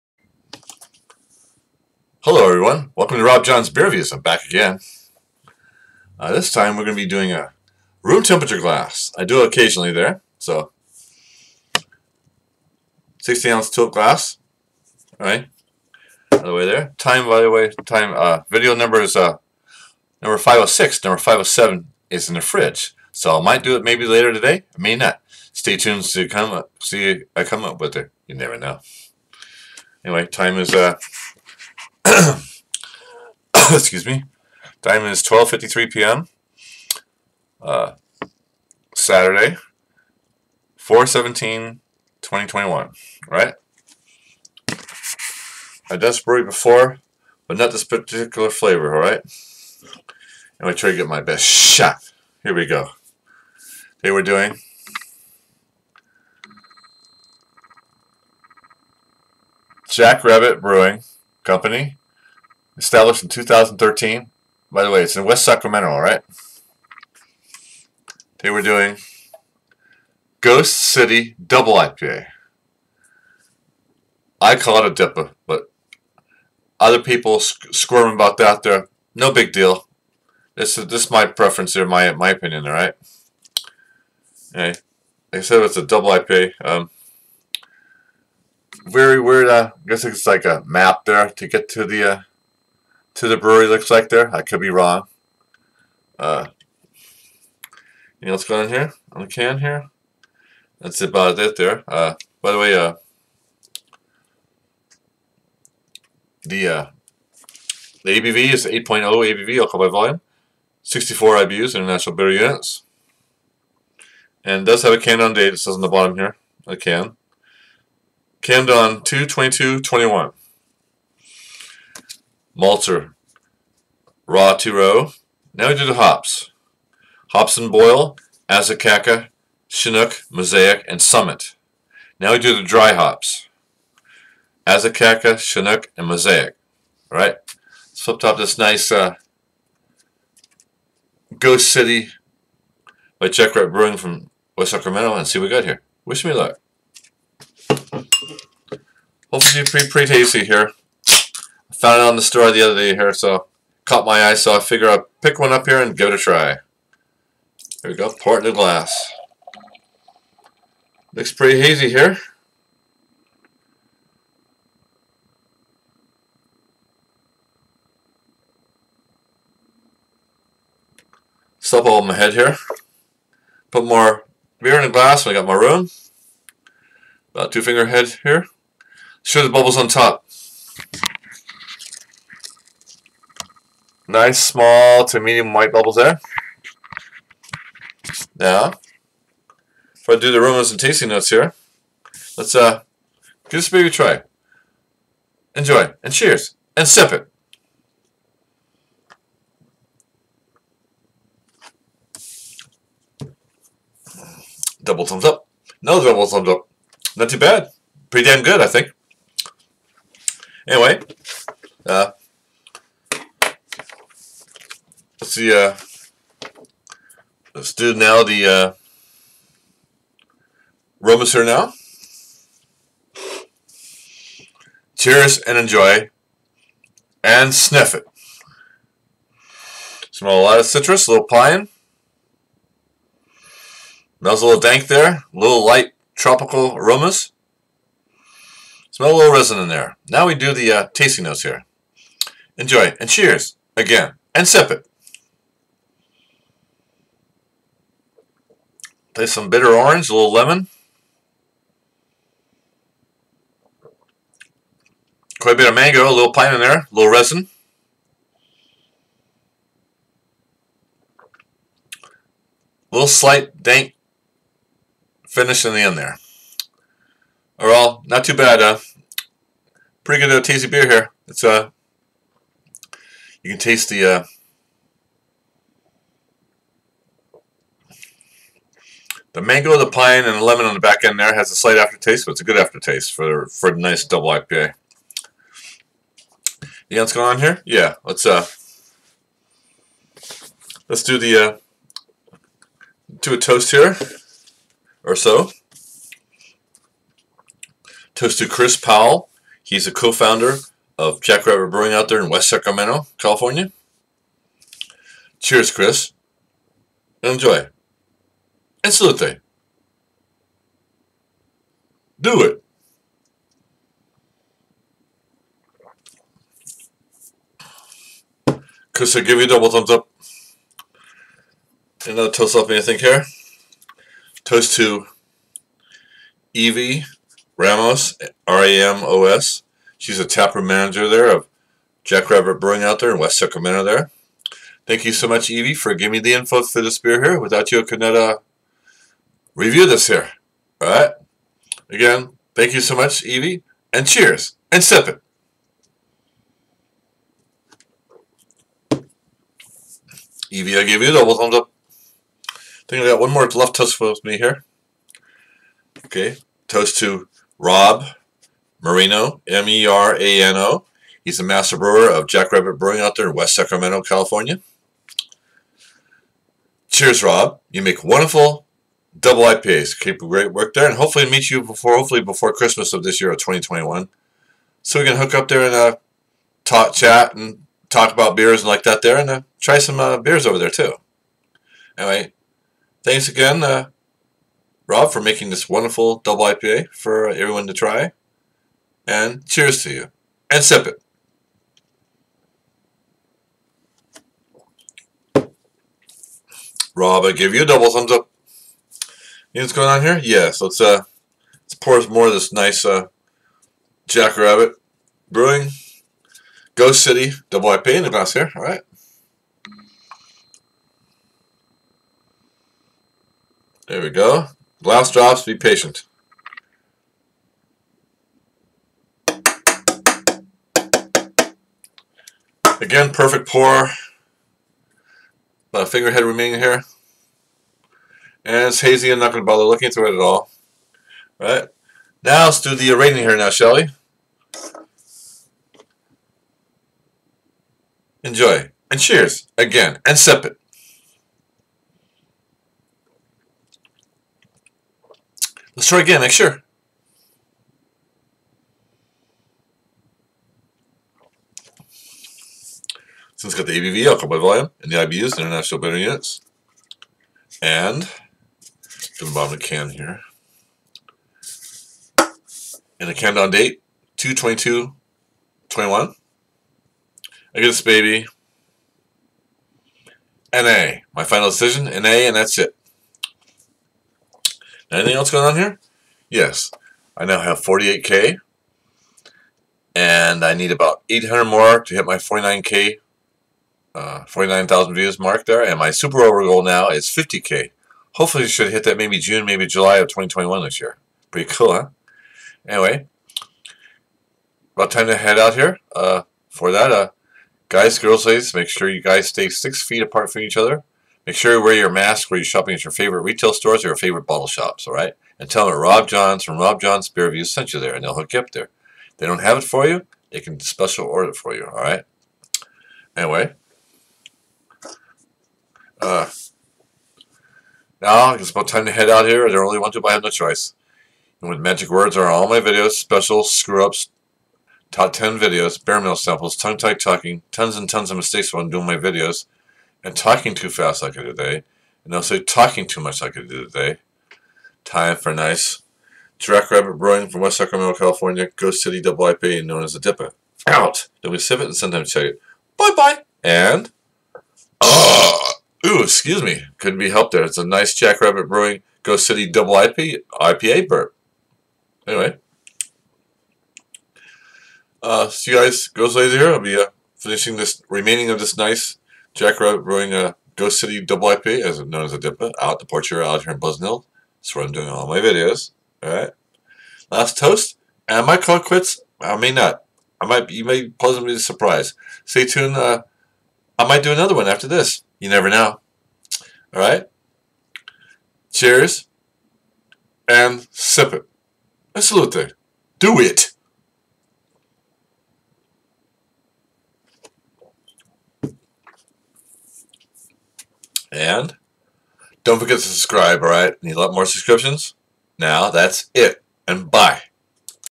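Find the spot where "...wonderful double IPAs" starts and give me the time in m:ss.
6:08.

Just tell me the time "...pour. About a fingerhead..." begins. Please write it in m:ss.
7:03.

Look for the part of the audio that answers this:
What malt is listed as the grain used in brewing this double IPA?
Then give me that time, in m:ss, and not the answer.
2:04.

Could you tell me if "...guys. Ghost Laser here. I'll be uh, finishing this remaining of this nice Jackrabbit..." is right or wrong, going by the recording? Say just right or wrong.
right.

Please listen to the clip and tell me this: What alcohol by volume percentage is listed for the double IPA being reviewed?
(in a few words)
8.0.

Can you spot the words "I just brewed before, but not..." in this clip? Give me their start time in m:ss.
0:45.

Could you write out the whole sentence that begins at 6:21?
Anyway, thanks again, uh, Rob, for making this wonderful double IPA for everyone to try, and cheers to you, and sip it.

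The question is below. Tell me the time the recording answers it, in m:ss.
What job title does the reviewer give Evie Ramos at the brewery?
5:30.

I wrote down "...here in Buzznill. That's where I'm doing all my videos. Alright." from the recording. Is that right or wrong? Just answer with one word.
right.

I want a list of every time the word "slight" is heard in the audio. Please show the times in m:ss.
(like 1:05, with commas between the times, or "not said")
4:23, 4:41.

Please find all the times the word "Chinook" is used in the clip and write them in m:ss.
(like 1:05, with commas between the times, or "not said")
2:09, 2:15.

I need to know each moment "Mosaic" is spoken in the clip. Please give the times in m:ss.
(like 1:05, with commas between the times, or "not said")
2:10, 2:16.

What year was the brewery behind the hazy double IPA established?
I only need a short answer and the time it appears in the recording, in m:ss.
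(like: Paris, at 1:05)
2013, at 1:03.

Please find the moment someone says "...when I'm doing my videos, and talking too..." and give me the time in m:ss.
8:48.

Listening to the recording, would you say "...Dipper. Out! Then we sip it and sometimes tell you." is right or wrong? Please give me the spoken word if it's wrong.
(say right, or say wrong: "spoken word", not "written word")
right.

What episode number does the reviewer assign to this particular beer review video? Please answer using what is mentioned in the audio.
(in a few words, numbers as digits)
506.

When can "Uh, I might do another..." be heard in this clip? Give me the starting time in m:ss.
9:32.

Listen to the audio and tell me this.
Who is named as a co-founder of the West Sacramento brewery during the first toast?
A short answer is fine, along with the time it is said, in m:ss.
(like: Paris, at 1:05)
Chris Powell, at 4:58.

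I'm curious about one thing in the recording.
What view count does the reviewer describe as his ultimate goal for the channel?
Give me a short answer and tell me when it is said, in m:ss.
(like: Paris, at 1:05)
50K, at 8:07.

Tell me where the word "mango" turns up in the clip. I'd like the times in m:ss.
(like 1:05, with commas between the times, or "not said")
4:15, 4:39.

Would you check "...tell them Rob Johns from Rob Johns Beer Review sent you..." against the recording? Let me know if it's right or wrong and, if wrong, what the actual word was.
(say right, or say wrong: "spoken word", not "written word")
right.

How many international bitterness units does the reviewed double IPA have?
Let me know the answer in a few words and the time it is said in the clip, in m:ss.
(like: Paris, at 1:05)
64, at 1:50.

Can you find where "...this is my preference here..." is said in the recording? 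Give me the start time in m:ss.
1:20.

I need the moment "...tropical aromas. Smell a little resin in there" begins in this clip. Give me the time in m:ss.
3:56.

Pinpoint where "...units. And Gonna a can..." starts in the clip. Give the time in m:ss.
7:35.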